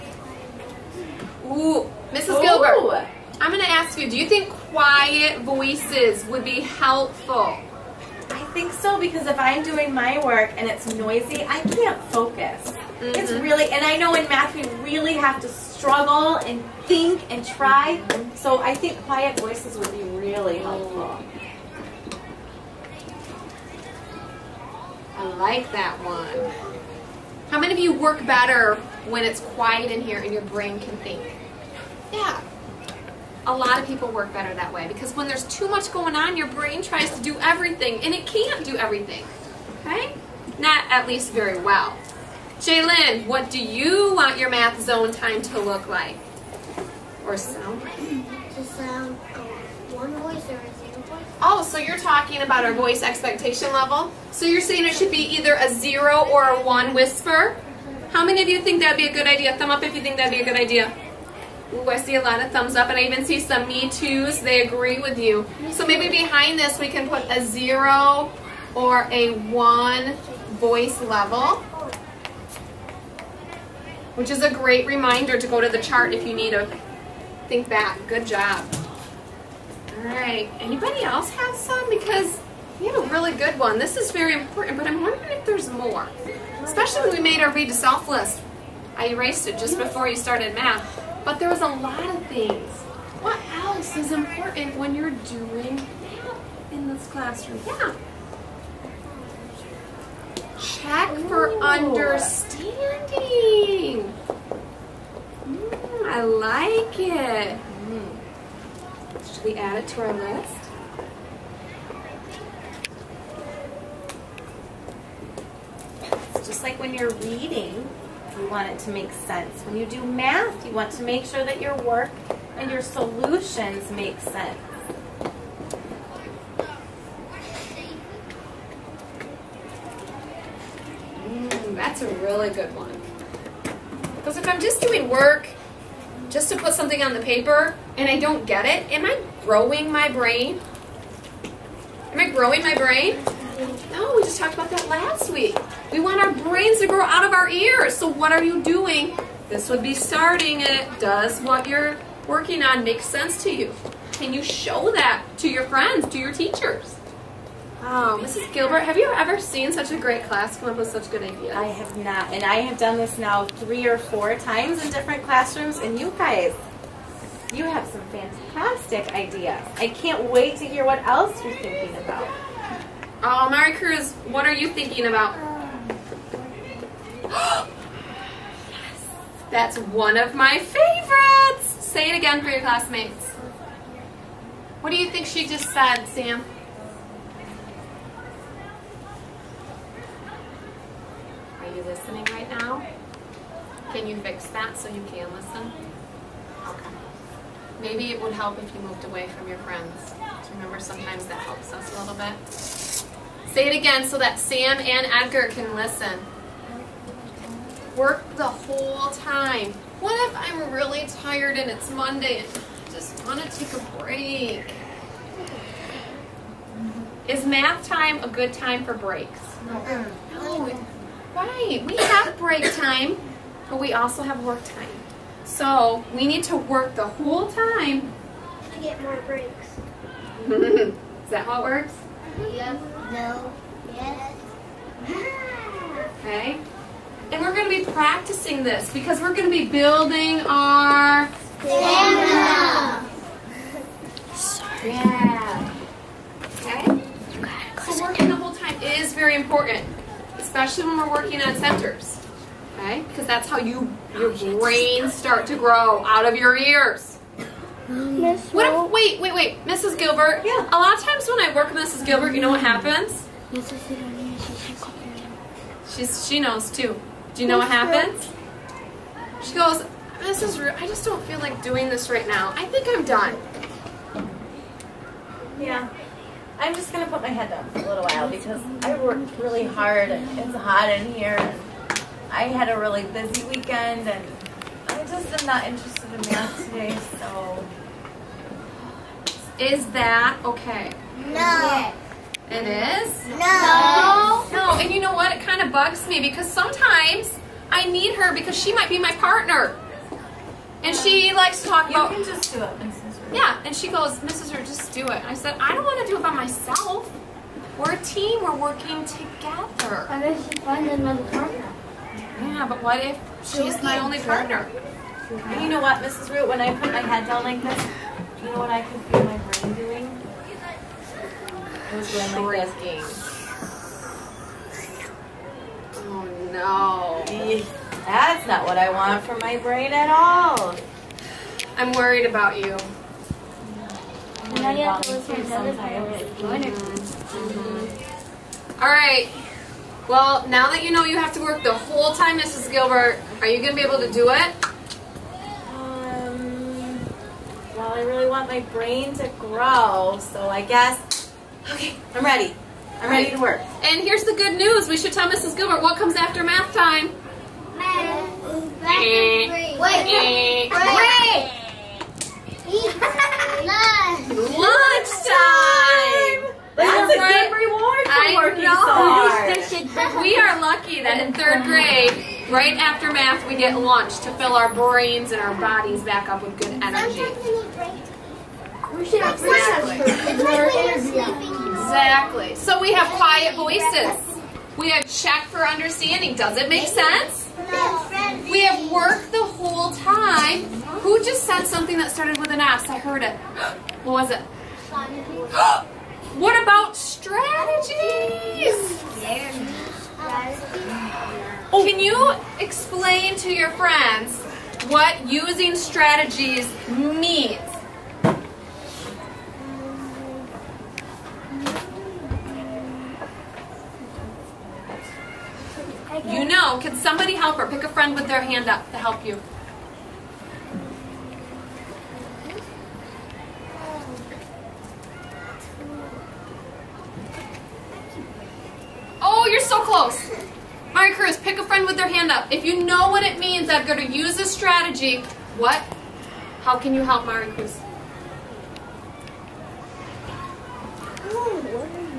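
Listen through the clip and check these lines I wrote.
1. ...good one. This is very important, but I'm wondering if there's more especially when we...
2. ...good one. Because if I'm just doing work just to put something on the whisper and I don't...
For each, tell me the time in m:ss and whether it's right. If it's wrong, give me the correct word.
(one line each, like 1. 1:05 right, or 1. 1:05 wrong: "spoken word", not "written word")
1. 1:23 right
2. 2:12 wrong: "paper", not "whisper".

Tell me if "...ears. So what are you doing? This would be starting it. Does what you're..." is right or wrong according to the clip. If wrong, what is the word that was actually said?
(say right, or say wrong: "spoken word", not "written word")
right.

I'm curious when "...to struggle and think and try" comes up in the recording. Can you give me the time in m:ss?
0:15.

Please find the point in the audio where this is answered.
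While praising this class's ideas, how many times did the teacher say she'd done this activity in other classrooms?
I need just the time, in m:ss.
2:43.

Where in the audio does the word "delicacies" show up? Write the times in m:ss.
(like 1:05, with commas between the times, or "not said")
not said.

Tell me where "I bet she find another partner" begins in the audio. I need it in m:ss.
5:10.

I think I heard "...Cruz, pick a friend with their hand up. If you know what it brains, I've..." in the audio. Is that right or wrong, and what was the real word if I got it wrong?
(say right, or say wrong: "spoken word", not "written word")
wrong: "means", not "brains".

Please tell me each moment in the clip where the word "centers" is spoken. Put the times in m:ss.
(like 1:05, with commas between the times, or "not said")
4:11.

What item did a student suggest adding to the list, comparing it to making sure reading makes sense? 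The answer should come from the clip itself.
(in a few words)
Check for understanding.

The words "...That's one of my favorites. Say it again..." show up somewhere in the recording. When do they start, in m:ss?
2:59.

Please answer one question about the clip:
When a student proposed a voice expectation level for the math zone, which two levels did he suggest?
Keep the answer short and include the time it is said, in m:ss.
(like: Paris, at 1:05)
0 or 1, at 0:49.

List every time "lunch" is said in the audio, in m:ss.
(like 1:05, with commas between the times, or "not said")
6:04, 6:13.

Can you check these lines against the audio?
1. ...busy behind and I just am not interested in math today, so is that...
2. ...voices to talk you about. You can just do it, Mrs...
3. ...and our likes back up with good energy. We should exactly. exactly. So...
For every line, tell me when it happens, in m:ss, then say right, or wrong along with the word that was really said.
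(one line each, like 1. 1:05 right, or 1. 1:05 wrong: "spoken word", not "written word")
1. 4:43 wrong: "weekend", not "behind"
2. 5:01 wrong: "likes", not "voices"
3. 6:15 wrong: "bodies", not "likes".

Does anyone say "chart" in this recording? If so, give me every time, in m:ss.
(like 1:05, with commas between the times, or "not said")
1:15.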